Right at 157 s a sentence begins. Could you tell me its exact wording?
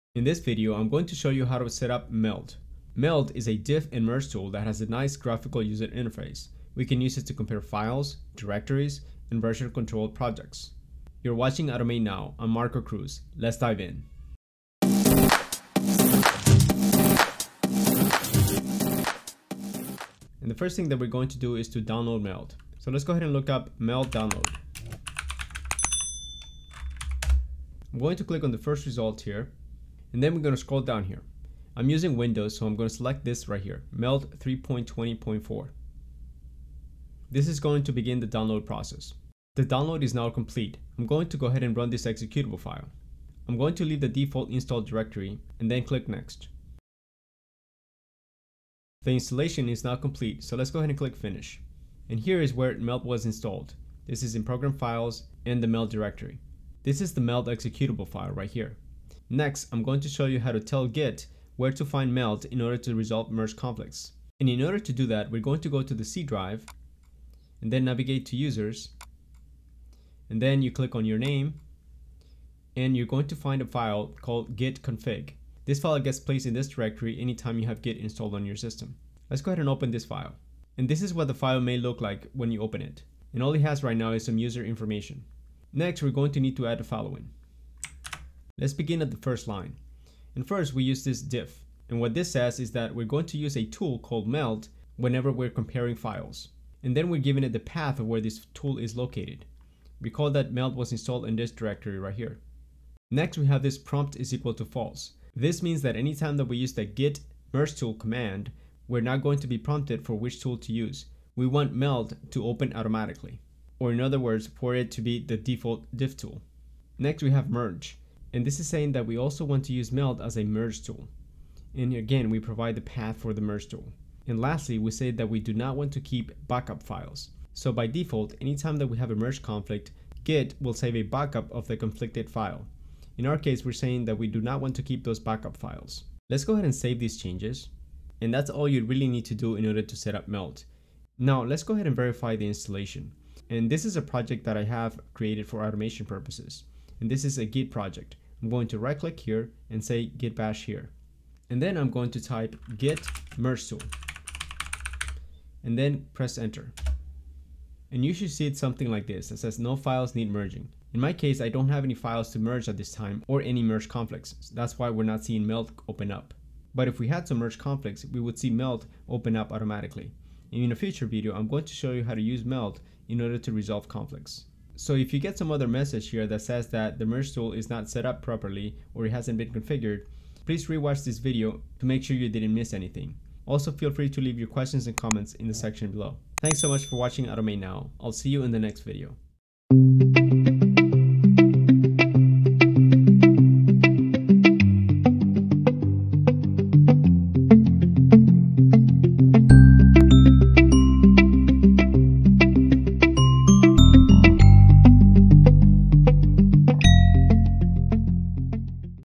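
And you should see it something like this that says no files need merging.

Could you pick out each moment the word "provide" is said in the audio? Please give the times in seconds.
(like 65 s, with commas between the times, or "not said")
122 s.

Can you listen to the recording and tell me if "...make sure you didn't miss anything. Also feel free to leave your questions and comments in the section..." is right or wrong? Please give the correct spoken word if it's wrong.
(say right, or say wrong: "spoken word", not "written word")
right.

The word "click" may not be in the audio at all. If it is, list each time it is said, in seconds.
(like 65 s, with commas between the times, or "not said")
28 s, 45 s, 50 s, 70 s, 148 s.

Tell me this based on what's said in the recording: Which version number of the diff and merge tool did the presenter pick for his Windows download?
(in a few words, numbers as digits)
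3.20.4.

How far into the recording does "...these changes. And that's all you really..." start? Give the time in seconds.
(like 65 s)
136 s.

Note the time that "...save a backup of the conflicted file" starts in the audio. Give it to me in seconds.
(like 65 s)
130 s.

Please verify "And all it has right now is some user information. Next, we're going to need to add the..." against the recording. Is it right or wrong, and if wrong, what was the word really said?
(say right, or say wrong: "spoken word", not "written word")
right.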